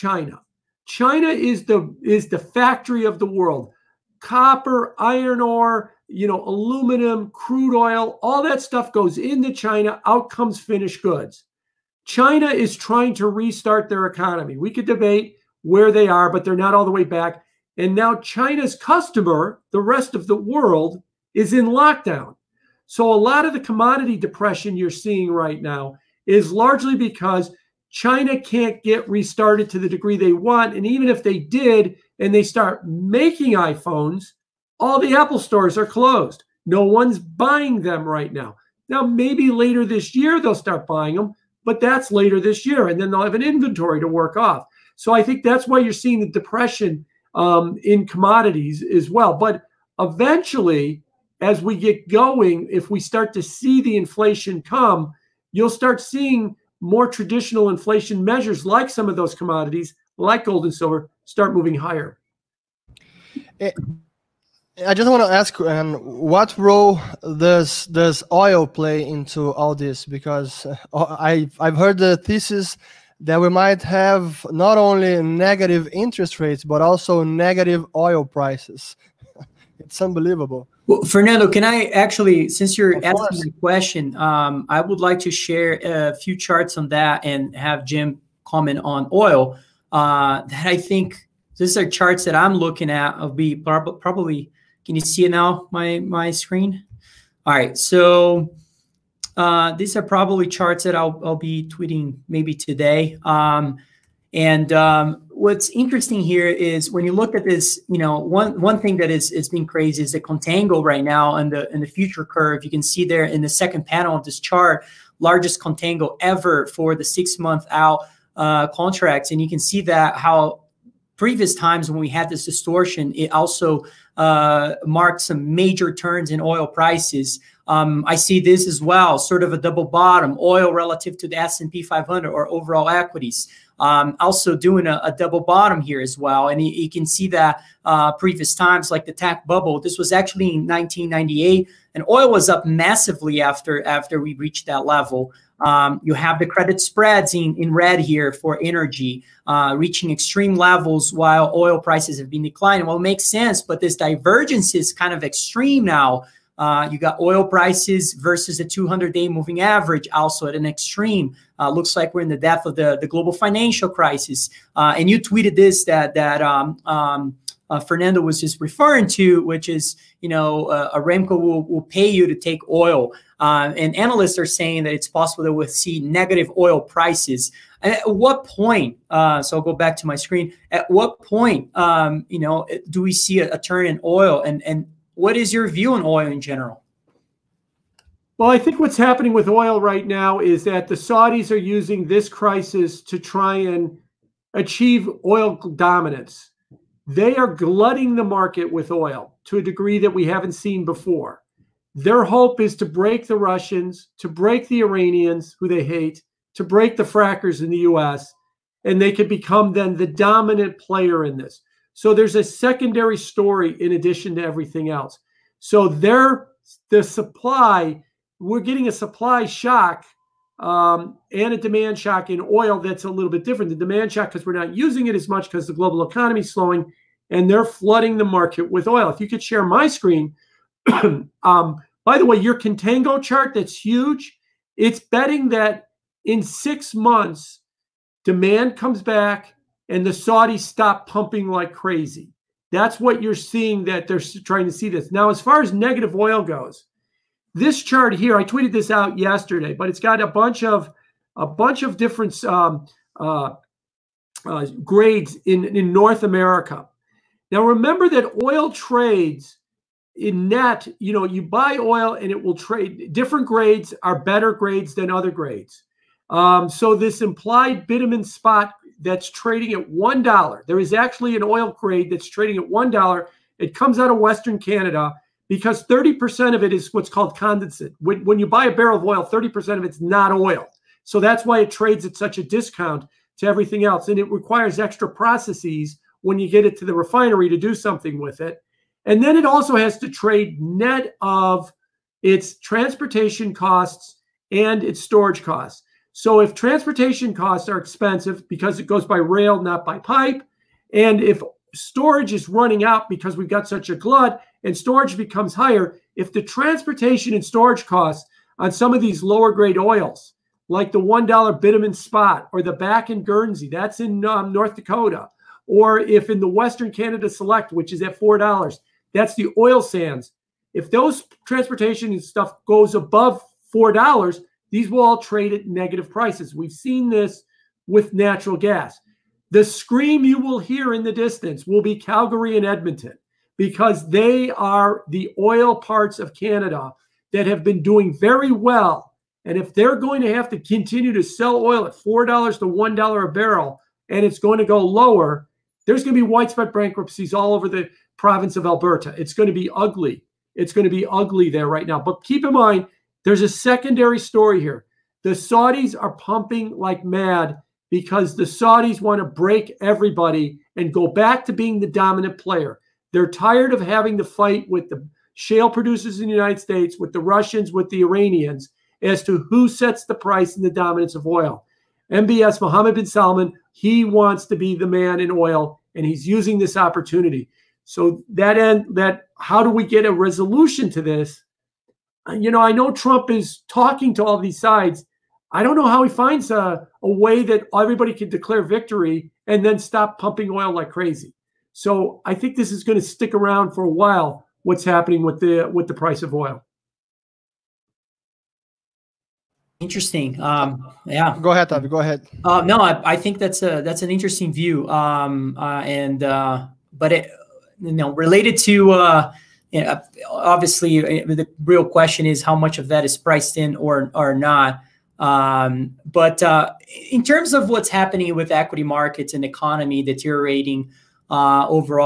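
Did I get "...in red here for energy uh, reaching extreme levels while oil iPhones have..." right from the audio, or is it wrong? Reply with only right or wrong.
wrong.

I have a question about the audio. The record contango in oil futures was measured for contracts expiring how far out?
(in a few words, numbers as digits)
6 months.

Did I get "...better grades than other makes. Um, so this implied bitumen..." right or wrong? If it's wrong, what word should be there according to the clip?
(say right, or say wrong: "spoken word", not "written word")
wrong: "grades", not "makes".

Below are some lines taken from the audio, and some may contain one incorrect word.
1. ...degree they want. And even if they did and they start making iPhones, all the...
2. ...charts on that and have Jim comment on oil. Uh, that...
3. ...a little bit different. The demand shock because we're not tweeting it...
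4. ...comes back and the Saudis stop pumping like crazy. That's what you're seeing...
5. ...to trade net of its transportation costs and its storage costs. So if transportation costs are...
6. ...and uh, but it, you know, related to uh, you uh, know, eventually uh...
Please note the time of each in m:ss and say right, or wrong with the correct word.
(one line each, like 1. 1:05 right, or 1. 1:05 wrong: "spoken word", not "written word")
1. 0:29 right
2. 1:26 right
3. 3:43 wrong: "using", not "tweeting"
4. 3:58 right
5. 4:49 right
6. 6:45 wrong: "obviously", not "eventually".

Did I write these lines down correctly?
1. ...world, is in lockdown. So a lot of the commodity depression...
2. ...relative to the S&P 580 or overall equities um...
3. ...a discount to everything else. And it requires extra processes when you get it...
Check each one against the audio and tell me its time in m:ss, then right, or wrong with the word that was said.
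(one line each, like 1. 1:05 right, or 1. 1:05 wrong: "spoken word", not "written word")
1. 0:20 right
2. 2:10 wrong: "500", not "580"
3. 4:42 right.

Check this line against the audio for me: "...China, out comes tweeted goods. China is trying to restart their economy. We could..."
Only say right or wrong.
wrong.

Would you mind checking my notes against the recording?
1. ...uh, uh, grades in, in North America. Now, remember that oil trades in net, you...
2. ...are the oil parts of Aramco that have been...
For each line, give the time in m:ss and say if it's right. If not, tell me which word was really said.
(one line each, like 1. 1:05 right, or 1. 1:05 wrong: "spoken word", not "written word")
1. 4:13 right
2. 5:34 wrong: "Canada", not "Aramco".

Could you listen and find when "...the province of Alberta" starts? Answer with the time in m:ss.
5:47.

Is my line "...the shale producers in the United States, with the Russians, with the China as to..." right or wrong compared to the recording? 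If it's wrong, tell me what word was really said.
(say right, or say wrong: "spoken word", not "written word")
wrong: "Iranians", not "China".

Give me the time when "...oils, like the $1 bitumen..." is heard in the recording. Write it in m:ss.
5:09.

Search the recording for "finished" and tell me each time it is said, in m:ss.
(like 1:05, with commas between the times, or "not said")
0:10.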